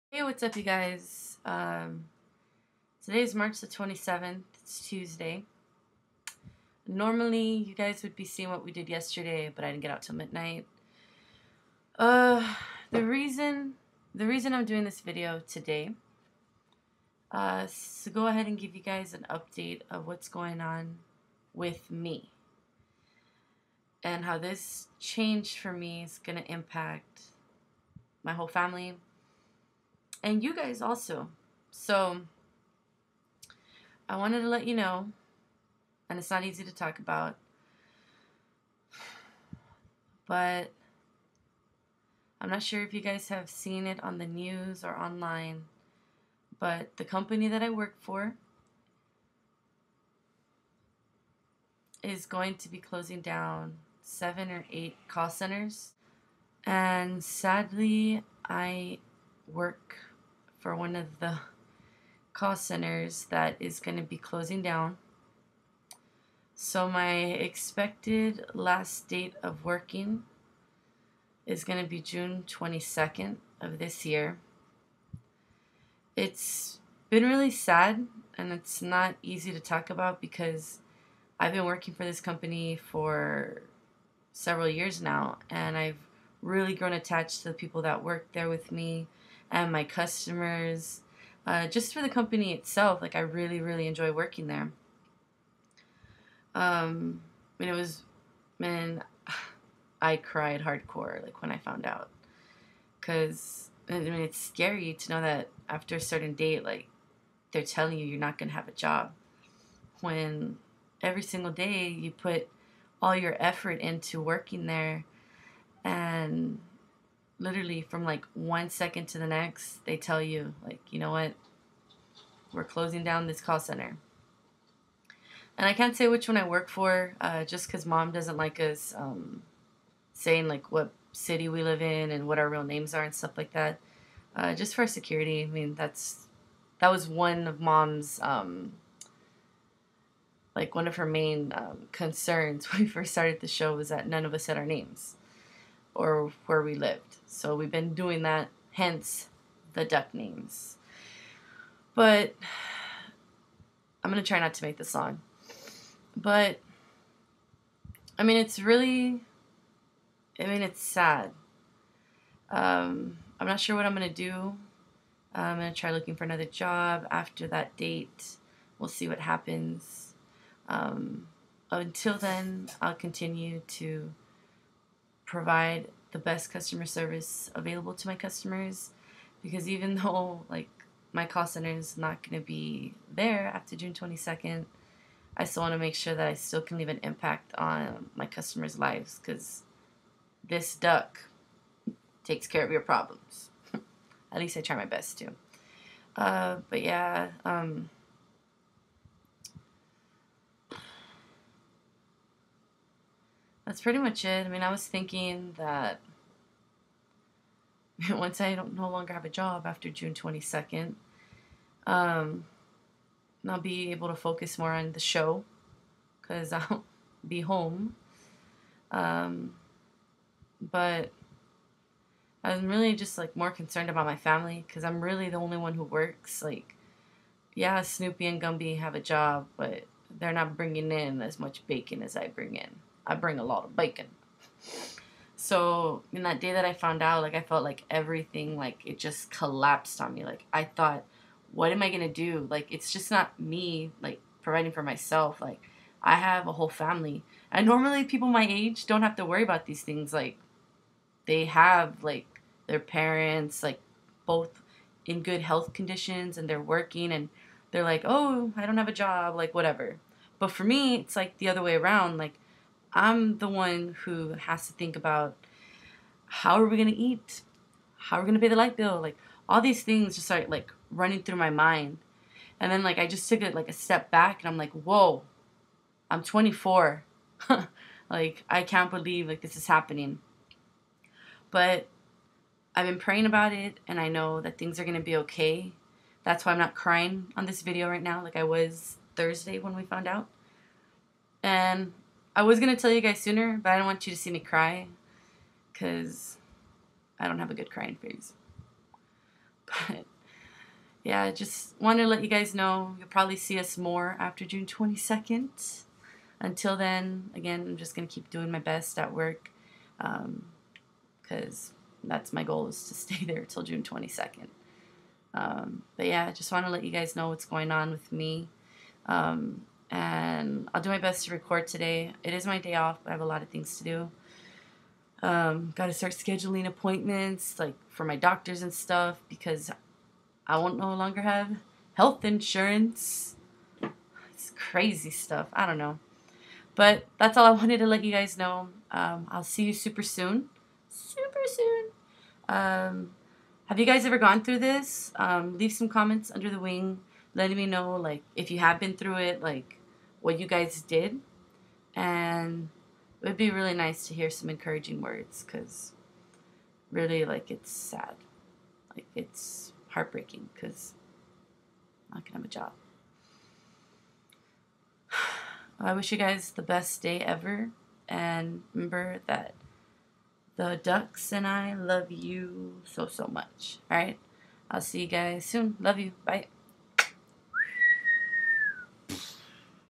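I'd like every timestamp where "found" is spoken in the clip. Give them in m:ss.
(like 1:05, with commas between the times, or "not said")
1:41, 3:56, 4:49.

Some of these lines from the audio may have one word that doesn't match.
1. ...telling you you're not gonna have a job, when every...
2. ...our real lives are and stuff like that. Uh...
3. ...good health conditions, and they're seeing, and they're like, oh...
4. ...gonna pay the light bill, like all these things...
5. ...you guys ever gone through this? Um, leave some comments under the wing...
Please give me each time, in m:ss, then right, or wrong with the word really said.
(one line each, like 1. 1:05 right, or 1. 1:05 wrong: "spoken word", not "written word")
1. 1:47 right
2. 2:12 wrong: "names", not "lives"
3. 4:15 wrong: "working", not "seeing"
4. 4:28 right
5. 5:43 right.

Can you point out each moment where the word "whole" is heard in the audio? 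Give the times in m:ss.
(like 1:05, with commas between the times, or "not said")
0:28, 4:06.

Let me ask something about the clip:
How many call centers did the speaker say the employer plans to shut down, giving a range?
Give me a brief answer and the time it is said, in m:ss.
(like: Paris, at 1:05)
7 or 8, at 0:54.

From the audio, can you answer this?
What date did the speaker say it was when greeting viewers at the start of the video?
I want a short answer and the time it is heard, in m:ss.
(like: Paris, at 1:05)
March 27th, at 0:03.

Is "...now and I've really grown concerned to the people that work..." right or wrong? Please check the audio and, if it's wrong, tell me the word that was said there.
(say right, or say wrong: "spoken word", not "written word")
wrong: "attached", not "concerned".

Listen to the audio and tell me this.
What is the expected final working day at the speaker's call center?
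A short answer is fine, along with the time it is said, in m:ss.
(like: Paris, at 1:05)
June 22nd, at 1:11.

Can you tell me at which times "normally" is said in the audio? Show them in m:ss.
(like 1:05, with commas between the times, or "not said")
0:06, 4:07.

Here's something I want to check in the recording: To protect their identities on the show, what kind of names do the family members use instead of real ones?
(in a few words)
Duck names.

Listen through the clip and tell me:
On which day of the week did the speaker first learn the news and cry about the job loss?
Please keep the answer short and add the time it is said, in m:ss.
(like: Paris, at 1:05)
Thursday, at 4:49.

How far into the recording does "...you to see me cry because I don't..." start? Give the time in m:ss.
4:54.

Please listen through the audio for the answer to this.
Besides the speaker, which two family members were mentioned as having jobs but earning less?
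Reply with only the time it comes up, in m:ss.
3:47.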